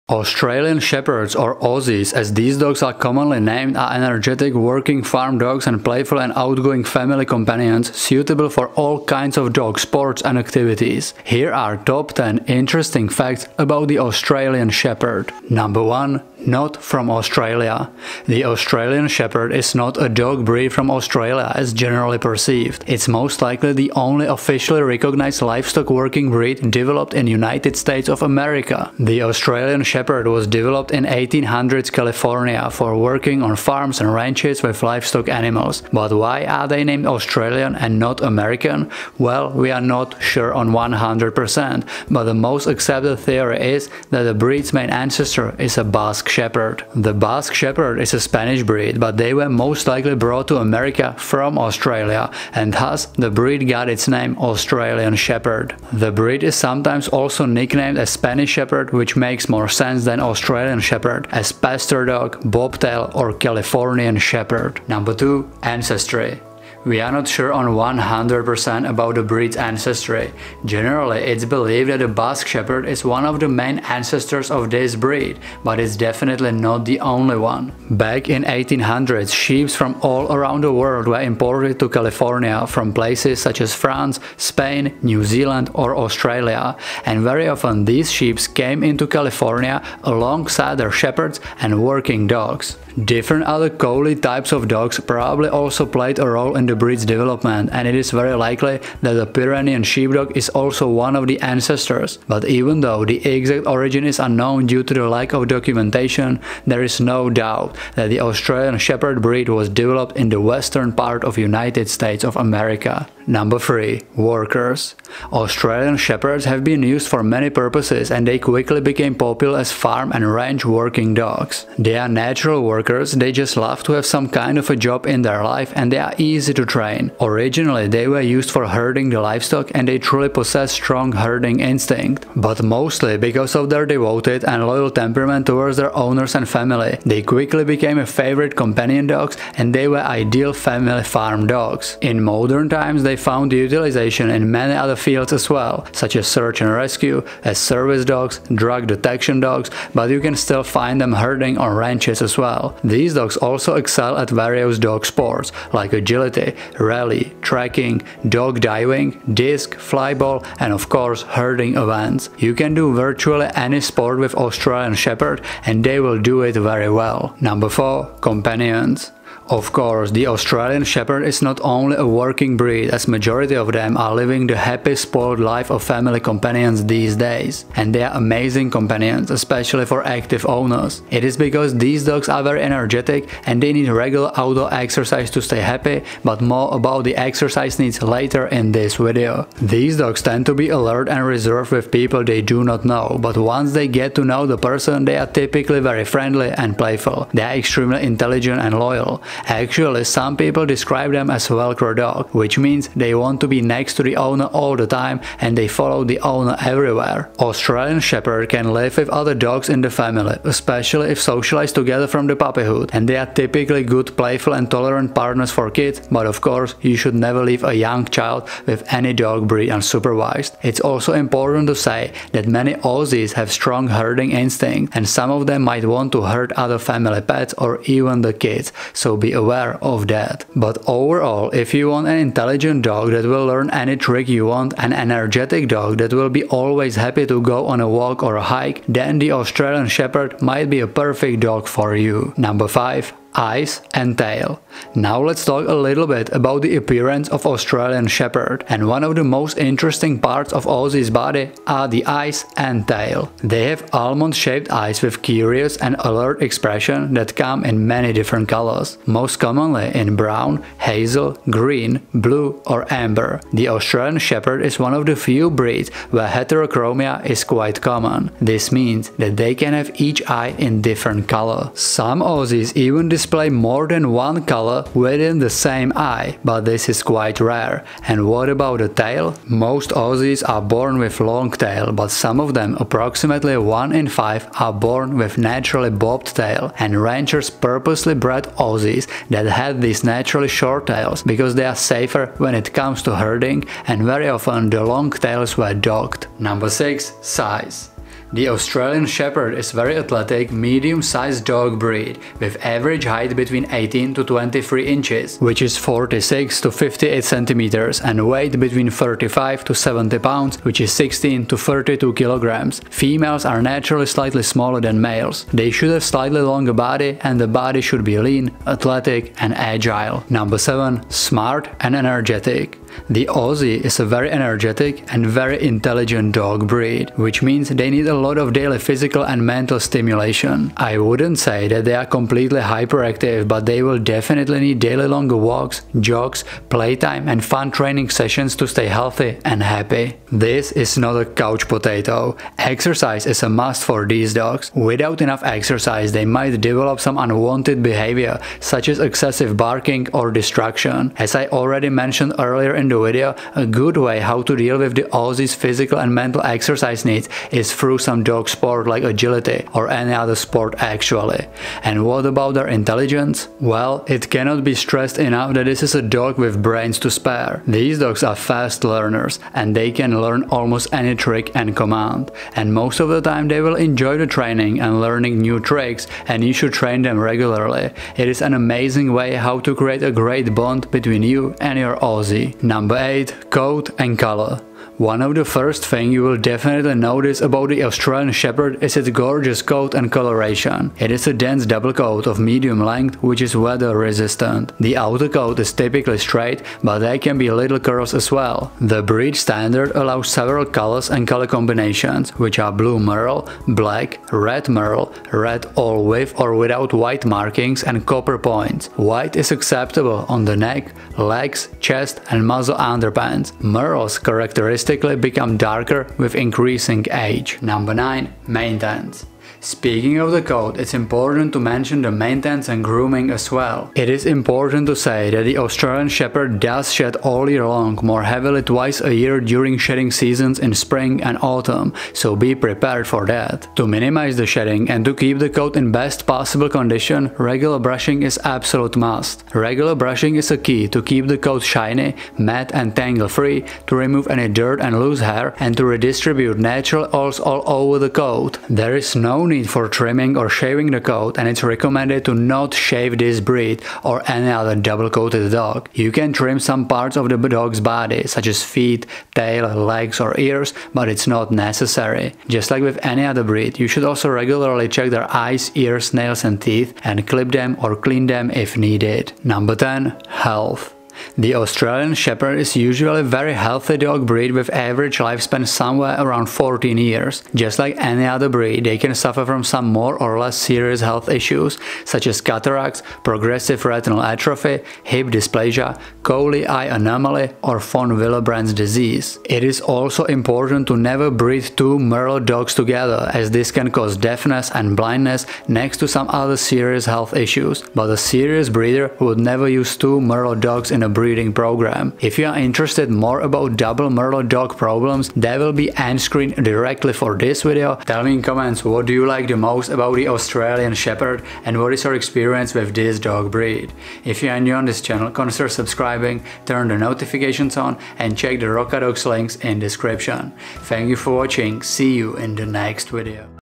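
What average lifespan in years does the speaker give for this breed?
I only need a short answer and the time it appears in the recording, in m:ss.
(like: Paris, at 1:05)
14 years, at 7:56.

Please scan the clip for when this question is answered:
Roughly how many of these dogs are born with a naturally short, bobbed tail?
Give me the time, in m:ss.
4:43.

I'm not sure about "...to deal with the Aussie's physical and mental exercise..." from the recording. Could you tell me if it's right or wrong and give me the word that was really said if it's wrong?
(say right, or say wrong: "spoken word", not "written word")
right.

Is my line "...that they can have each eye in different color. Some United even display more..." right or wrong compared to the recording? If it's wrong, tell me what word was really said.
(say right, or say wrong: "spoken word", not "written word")
wrong: "Aussies", not "United".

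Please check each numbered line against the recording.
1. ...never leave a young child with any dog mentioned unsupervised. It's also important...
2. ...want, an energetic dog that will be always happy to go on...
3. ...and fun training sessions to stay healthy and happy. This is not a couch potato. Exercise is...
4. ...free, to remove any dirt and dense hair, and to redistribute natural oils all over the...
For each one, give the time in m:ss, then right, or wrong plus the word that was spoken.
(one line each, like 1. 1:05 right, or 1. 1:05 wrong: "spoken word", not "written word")
1. 3:37 wrong: "breed", not "mentioned"
2. 3:54 right
3. 5:37 right
4. 7:23 wrong: "loose", not "dense".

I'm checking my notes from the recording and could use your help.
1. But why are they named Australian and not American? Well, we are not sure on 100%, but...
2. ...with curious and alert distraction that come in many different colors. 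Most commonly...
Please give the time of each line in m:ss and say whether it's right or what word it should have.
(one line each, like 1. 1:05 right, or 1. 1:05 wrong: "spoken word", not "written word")
1. 0:35 right
2. 4:15 wrong: "expression", not "distraction".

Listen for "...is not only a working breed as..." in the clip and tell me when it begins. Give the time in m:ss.
2:51.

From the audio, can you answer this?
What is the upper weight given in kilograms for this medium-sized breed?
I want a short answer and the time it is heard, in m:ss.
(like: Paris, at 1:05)
32 kilograms, at 5:11.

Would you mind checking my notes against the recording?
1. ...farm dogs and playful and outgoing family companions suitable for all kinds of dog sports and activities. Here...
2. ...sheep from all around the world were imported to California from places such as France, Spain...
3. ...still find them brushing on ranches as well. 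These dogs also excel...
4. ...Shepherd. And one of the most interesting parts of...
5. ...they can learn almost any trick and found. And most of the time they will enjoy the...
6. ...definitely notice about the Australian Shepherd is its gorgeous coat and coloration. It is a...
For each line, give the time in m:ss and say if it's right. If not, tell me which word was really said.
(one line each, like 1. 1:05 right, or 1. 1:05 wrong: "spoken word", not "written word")
1. 0:05 right
2. 1:19 right
3. 2:30 wrong: "herding", not "brushing"
4. 4:08 right
5. 6:09 wrong: "command", not "found"
6. 6:26 right.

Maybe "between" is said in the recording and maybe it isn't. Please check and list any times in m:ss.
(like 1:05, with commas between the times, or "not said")
5:03, 5:08, 6:20.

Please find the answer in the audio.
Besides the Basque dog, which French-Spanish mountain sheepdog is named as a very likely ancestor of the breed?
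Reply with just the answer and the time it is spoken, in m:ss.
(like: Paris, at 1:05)
Pyrenean sheepdog, at 1:39.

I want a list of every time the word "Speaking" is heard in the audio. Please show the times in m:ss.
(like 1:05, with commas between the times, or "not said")
6:59.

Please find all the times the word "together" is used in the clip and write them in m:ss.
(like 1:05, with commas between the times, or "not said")
3:31, 8:12.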